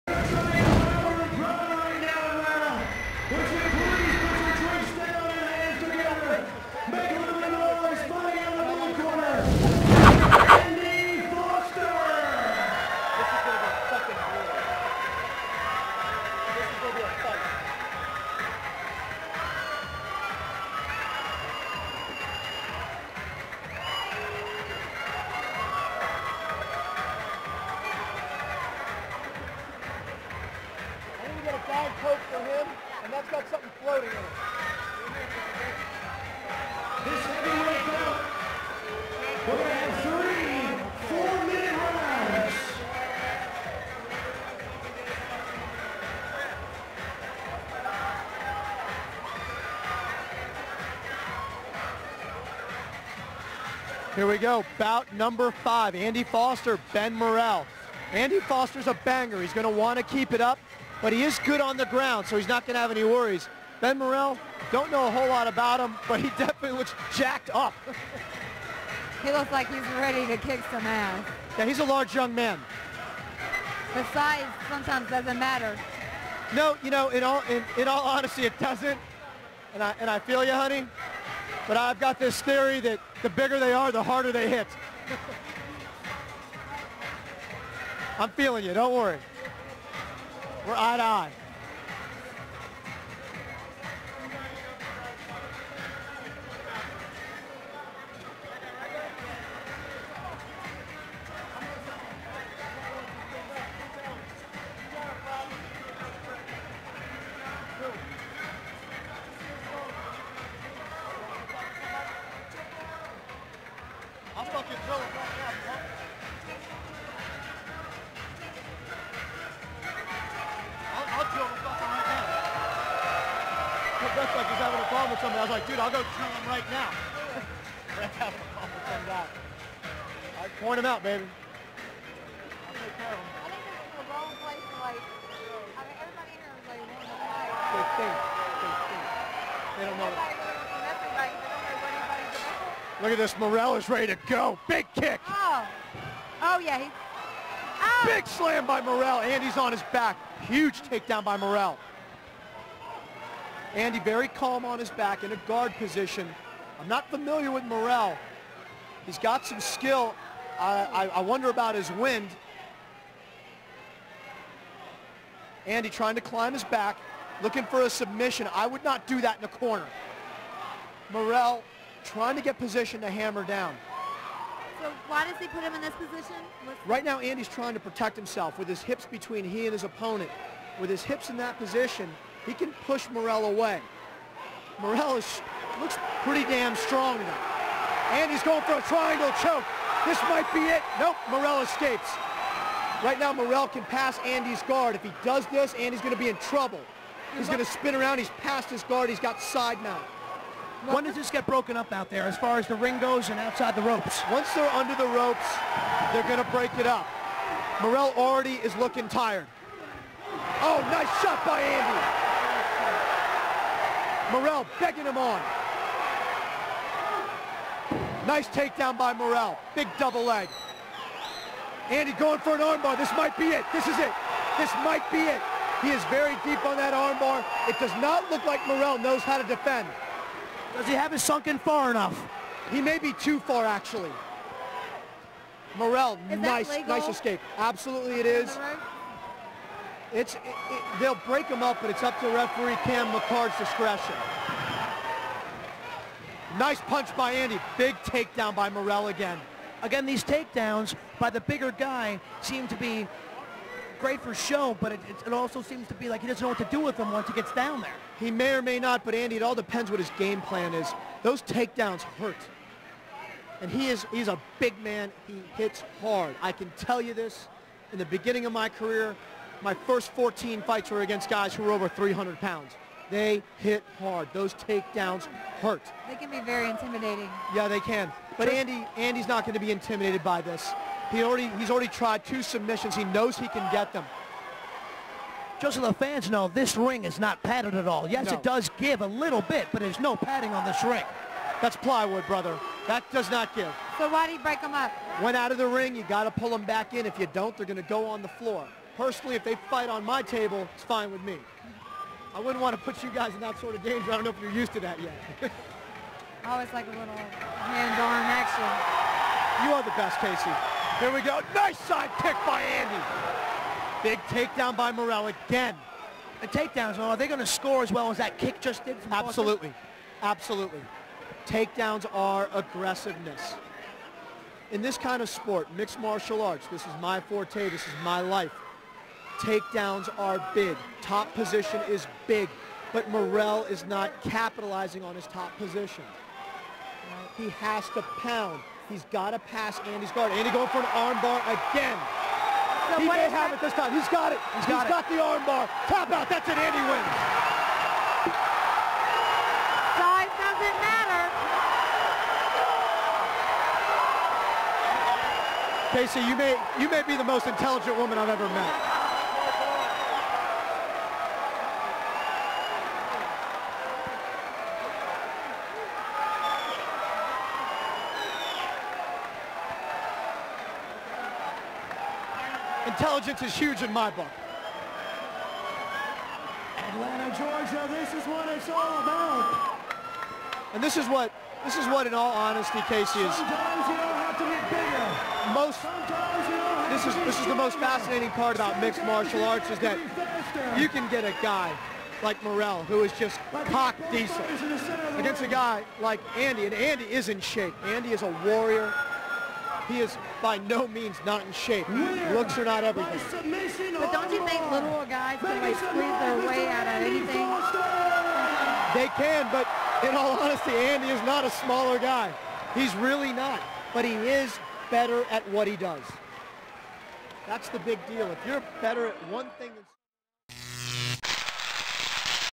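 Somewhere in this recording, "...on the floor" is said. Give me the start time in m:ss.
4:58.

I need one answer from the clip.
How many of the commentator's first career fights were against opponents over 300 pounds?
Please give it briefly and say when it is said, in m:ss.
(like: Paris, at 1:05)
14, at 4:30.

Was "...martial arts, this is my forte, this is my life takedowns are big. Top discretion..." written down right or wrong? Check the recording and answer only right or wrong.
wrong.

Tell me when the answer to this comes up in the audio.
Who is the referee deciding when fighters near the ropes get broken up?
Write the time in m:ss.
4:02.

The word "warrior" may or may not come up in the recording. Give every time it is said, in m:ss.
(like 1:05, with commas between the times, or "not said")
6:38.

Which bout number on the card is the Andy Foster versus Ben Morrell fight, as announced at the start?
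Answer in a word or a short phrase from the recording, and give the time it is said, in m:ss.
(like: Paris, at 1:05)
5, at 0:54.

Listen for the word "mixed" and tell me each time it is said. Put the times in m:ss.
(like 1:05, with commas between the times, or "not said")
5:25, 6:28.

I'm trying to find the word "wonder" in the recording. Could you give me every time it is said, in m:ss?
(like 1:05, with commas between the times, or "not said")
2:41.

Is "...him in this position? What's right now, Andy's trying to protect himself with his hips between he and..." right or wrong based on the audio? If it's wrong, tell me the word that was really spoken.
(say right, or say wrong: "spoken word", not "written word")
right.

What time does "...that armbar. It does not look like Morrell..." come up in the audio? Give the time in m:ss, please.
3:46.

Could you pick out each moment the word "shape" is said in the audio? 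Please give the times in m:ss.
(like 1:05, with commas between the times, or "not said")
6:37, 6:41.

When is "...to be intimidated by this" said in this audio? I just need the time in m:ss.
4:39.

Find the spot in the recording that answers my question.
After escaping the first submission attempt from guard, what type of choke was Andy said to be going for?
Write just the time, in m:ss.
3:08.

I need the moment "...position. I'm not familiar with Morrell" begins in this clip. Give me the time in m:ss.
2:35.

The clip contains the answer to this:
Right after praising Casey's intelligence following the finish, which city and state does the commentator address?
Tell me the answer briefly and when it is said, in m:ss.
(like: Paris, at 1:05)
Atlanta, Georgia, at 6:16.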